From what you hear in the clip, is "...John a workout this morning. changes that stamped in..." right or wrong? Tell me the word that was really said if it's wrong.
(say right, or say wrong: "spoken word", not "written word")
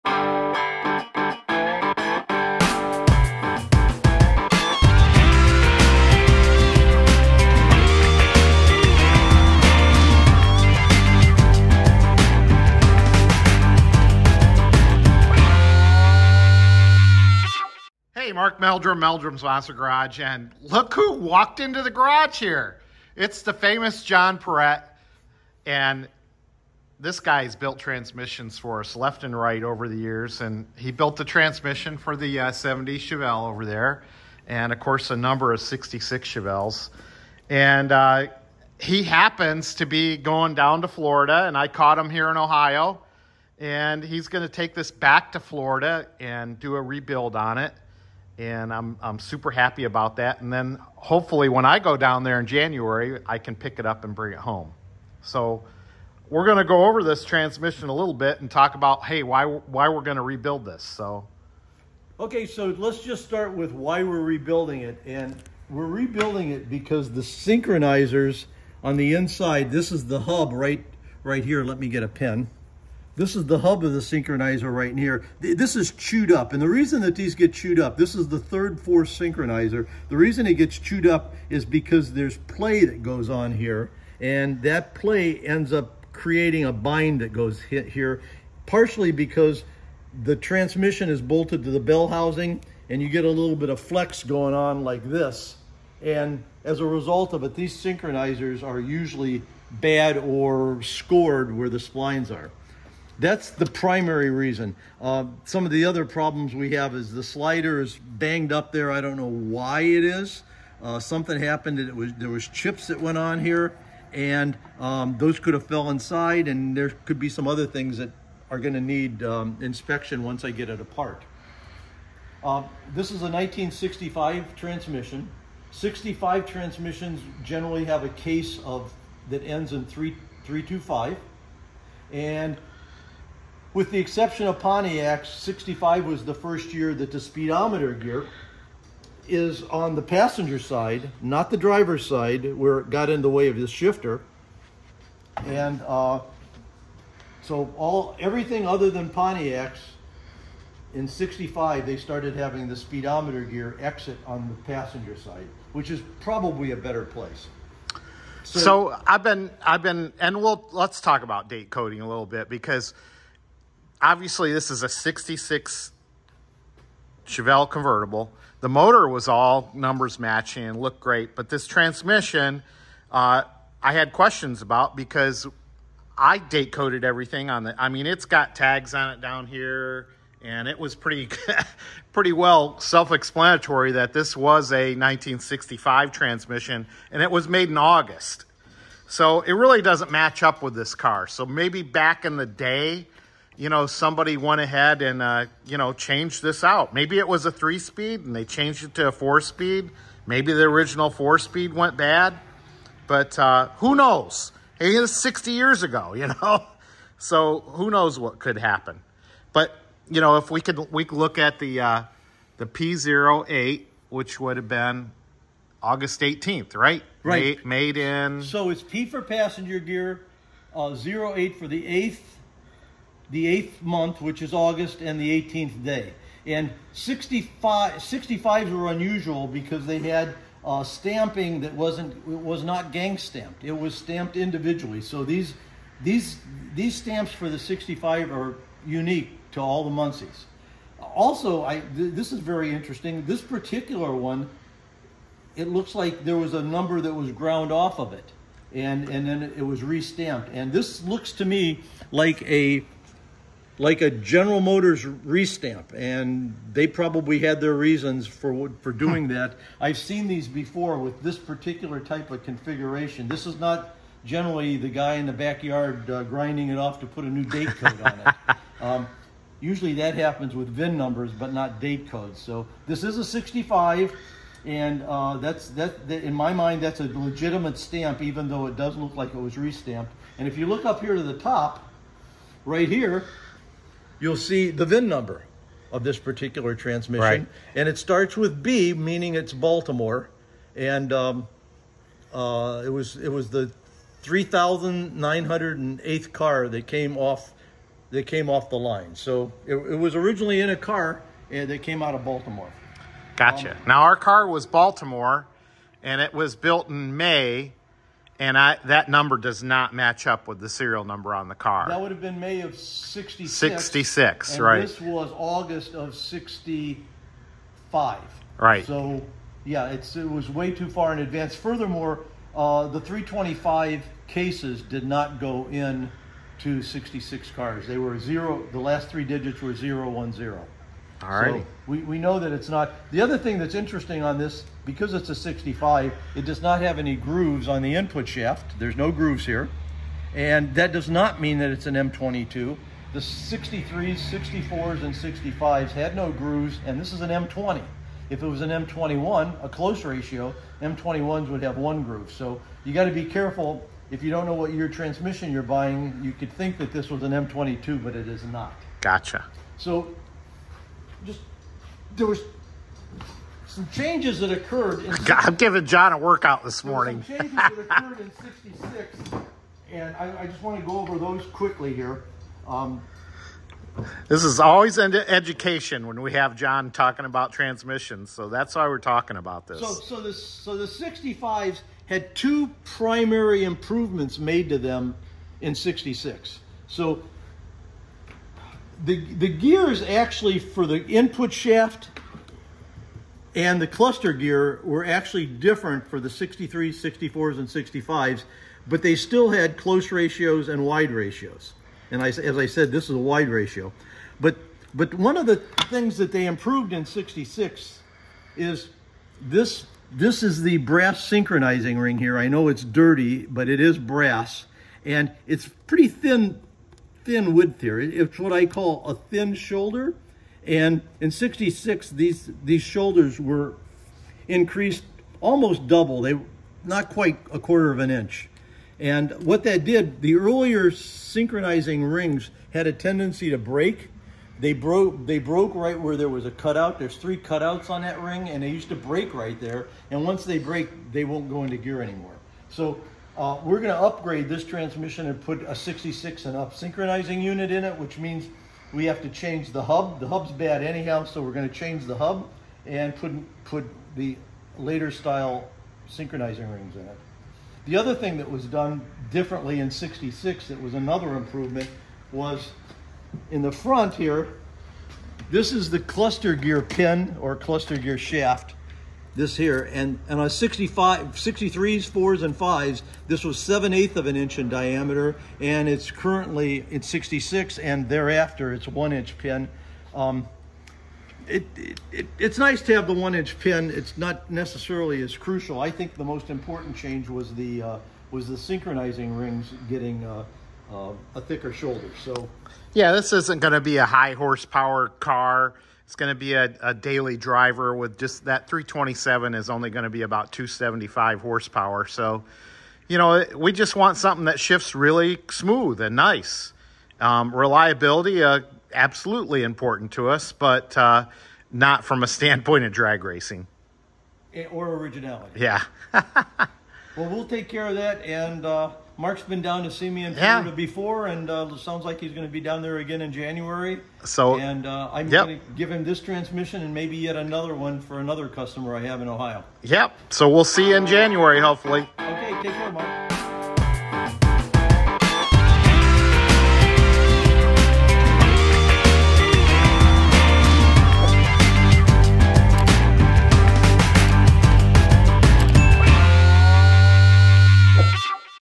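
wrong: "occurred", not "stamped".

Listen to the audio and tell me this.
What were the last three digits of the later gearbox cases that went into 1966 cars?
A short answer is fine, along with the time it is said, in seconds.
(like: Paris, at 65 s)
010, at 329 s.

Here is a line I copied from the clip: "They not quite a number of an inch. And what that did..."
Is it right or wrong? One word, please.
wrong.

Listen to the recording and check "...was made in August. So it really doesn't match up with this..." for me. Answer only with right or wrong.
right.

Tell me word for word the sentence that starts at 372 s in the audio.
Um, this is always into education when we have John talking about transmissions, so that's why we're talking about this.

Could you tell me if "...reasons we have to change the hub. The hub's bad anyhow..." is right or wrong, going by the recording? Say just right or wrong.
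wrong.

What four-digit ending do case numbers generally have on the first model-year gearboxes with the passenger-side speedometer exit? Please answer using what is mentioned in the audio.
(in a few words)
3325.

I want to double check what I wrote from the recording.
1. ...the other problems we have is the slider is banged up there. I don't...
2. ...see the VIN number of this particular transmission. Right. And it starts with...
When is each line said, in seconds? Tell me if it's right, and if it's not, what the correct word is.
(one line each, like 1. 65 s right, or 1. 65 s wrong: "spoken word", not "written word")
1. 105 s right
2. 284 s right.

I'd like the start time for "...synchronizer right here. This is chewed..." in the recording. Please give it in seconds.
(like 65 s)
73 s.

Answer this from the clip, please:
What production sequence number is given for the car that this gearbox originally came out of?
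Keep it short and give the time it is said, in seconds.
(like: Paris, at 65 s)
3,908th, at 294 s.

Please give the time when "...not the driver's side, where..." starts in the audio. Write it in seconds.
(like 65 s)
141 s.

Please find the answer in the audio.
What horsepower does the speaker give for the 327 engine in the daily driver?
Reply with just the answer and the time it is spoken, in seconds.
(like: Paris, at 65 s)
275, at 500 s.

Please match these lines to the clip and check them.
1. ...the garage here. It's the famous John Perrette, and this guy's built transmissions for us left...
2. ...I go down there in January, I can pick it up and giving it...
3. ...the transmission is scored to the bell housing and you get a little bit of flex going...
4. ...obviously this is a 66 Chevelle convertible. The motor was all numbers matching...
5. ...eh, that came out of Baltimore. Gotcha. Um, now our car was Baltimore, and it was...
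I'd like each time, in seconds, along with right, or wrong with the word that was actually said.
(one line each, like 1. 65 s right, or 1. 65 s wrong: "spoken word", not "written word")
1. 21 s right
2. 51 s wrong: "bring", not "giving"
3. 90 s wrong: "bolted", not "scored"
4. 164 s right
5. 301 s right.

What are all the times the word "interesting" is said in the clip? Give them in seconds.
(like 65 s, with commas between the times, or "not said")
242 s, 333 s.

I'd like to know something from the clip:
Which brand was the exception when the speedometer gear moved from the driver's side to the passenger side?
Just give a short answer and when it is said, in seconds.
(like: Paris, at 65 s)
Pontiac, at 134 s.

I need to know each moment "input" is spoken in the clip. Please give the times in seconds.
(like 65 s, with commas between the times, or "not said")
337 s, 391 s.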